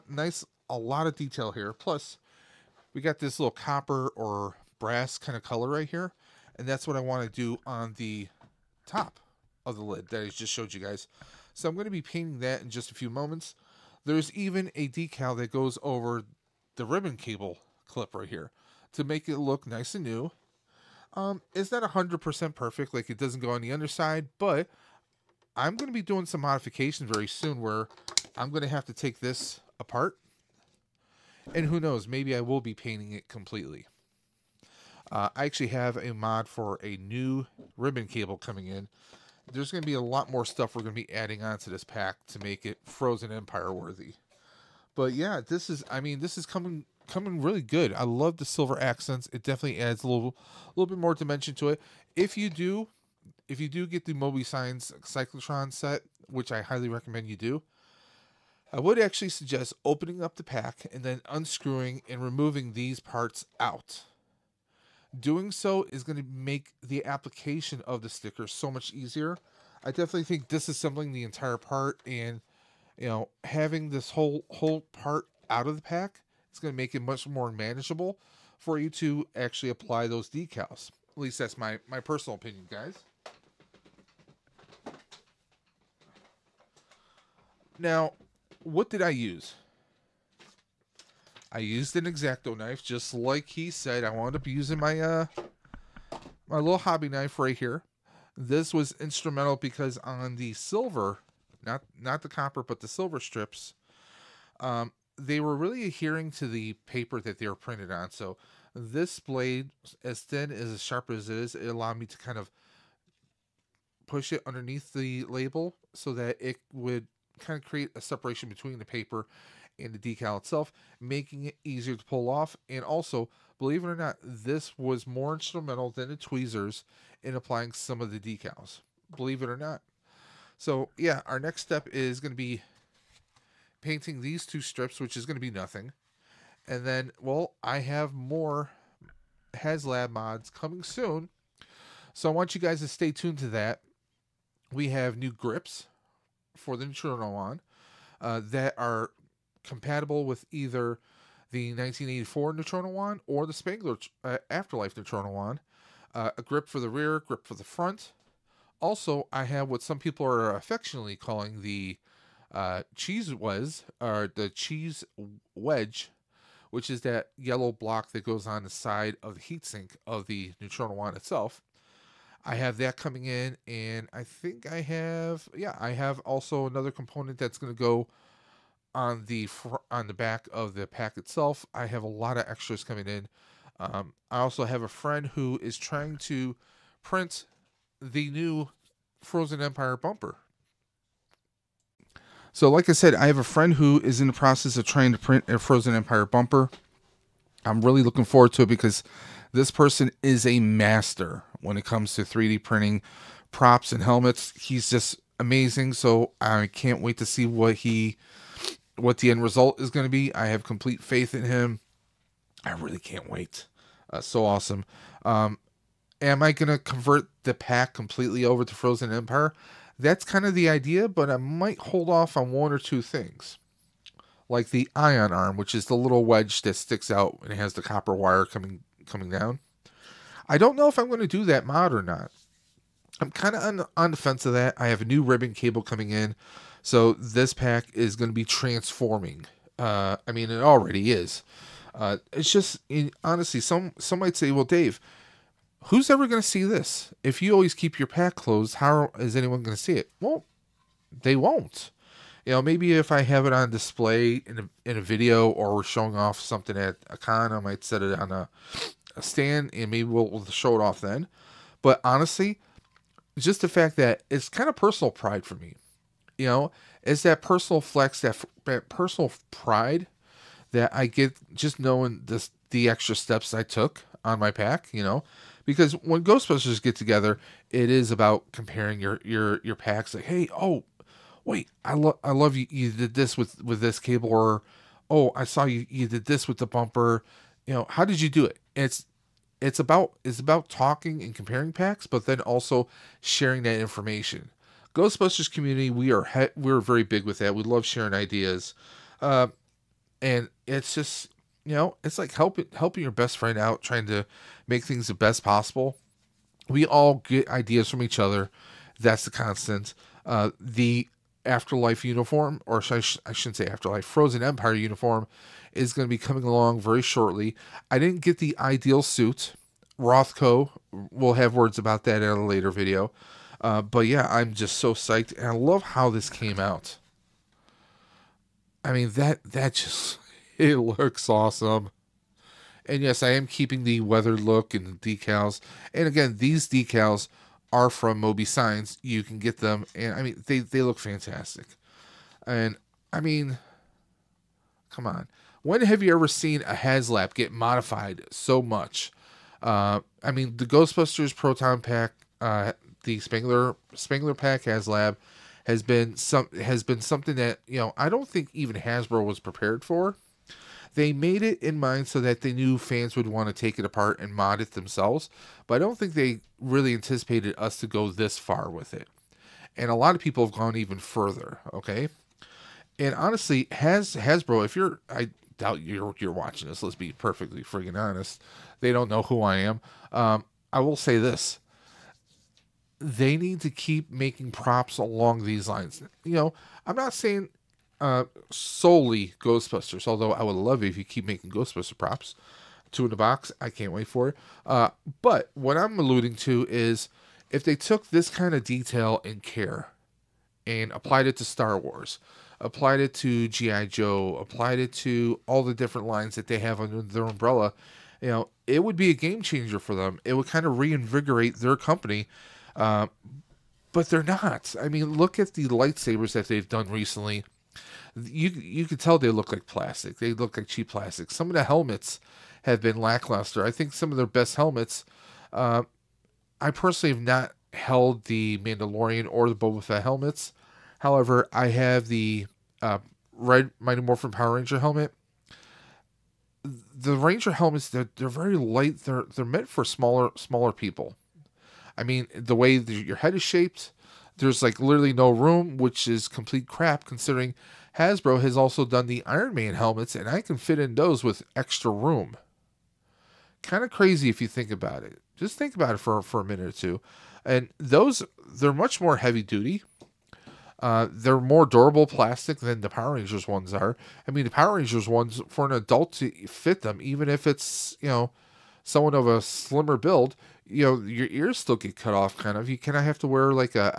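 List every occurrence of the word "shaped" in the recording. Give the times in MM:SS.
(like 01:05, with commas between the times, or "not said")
07:23.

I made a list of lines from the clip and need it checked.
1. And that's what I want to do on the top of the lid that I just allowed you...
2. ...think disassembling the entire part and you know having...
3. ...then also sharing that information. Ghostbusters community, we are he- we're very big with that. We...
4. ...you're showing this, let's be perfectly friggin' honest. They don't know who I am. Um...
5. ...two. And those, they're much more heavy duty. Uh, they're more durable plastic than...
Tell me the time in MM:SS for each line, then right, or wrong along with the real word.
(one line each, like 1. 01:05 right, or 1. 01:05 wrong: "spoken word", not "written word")
1. 00:06 wrong: "showed", not "allowed"
2. 01:10 right
3. 04:52 right
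4. 06:16 wrong: "watching", not "showing"
5. 07:36 right.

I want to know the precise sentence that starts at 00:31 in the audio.
And who knows, maybe I will be painting it completely.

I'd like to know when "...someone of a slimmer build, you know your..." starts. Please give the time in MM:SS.
07:48.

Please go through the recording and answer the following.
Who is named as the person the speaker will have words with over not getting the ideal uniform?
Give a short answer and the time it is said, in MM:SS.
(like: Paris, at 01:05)
Rothko, at 05:19.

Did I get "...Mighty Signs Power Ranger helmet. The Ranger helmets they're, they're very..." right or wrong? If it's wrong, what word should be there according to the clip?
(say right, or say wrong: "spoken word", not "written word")
wrong: "Morphin", not "Signs".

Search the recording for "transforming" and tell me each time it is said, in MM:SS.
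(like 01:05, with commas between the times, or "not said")
03:58.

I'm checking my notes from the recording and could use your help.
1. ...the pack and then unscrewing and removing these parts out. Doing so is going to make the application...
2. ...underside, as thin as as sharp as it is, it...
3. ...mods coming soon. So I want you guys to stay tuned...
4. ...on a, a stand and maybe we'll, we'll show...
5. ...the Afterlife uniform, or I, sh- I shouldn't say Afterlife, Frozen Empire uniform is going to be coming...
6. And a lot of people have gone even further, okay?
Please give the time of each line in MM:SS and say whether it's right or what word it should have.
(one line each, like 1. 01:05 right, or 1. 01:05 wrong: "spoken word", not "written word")
1. 01:00 right
2. 01:49 wrong: "blade", not "underside"
3. 02:20 right
4. 04:18 right
5. 05:10 right
6. 06:09 right.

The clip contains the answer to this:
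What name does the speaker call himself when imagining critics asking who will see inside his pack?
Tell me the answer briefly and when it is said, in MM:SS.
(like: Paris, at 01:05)
Dave, at 04:04.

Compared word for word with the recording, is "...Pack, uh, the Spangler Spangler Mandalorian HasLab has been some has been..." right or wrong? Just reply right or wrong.
wrong.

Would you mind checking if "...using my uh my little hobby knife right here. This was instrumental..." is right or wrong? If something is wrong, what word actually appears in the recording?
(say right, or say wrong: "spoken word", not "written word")
right.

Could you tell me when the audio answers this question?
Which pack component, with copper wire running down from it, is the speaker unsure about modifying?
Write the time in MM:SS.
03:44.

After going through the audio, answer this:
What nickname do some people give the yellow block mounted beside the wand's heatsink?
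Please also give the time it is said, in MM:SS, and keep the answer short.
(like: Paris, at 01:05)
cheese wedge, at 02:44.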